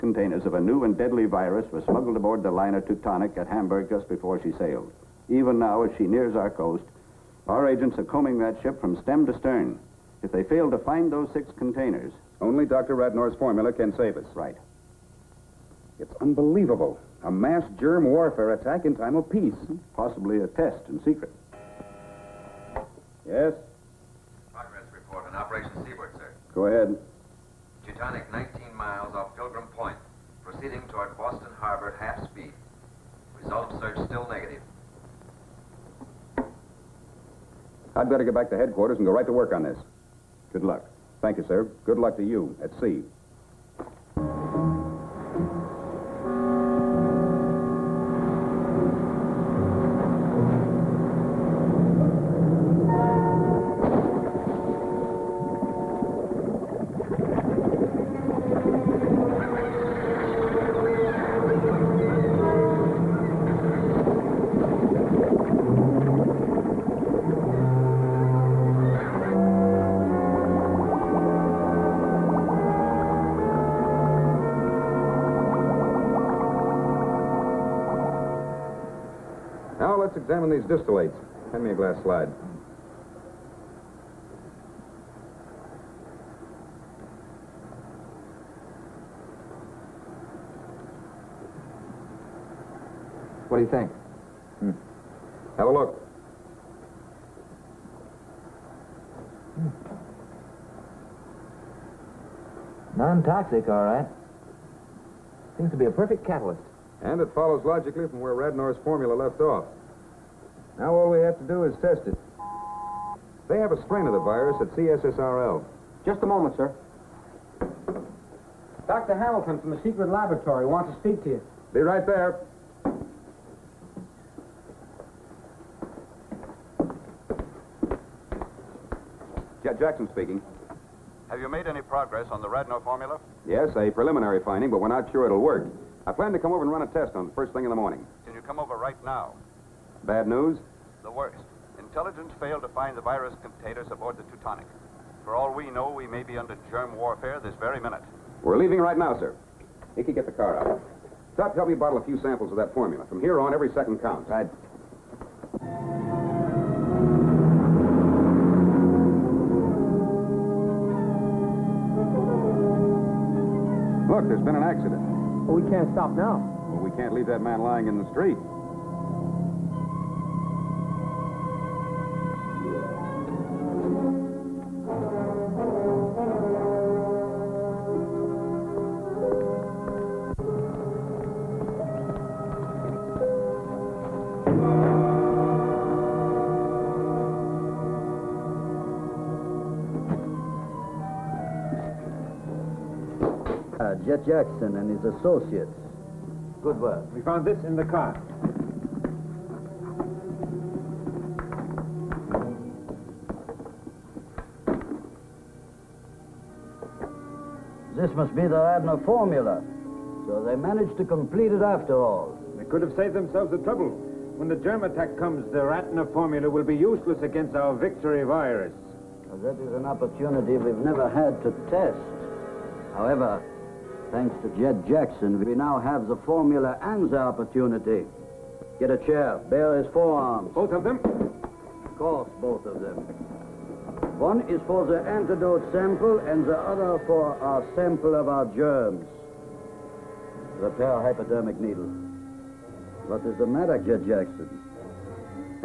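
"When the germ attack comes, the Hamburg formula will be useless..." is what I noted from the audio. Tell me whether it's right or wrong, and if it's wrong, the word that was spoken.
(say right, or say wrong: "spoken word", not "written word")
wrong: "Radnor", not "Hamburg".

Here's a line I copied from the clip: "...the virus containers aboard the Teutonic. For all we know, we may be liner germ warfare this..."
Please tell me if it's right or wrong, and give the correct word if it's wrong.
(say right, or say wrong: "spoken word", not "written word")
wrong: "under", not "liner".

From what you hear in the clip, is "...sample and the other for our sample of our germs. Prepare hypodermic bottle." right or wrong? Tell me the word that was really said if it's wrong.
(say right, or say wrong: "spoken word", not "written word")
wrong: "needle", not "bottle".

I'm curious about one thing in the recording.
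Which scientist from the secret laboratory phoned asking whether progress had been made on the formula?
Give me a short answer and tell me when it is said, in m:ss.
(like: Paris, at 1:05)
Dr. Hamilton, at 1:58.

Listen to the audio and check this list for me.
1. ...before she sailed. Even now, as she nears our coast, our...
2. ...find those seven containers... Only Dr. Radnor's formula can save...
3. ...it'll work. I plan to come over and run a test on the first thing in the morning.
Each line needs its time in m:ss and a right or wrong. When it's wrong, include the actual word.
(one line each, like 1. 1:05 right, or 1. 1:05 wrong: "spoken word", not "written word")
1. 0:04 right
2. 0:10 wrong: "six", not "seven"
3. 2:15 right.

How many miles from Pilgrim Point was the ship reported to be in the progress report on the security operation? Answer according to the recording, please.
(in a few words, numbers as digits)
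19.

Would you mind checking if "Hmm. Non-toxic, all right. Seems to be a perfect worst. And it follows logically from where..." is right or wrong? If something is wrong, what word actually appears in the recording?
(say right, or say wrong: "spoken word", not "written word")
wrong: "catalyst", not "worst".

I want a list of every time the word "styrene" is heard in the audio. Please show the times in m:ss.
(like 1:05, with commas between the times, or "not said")
not said.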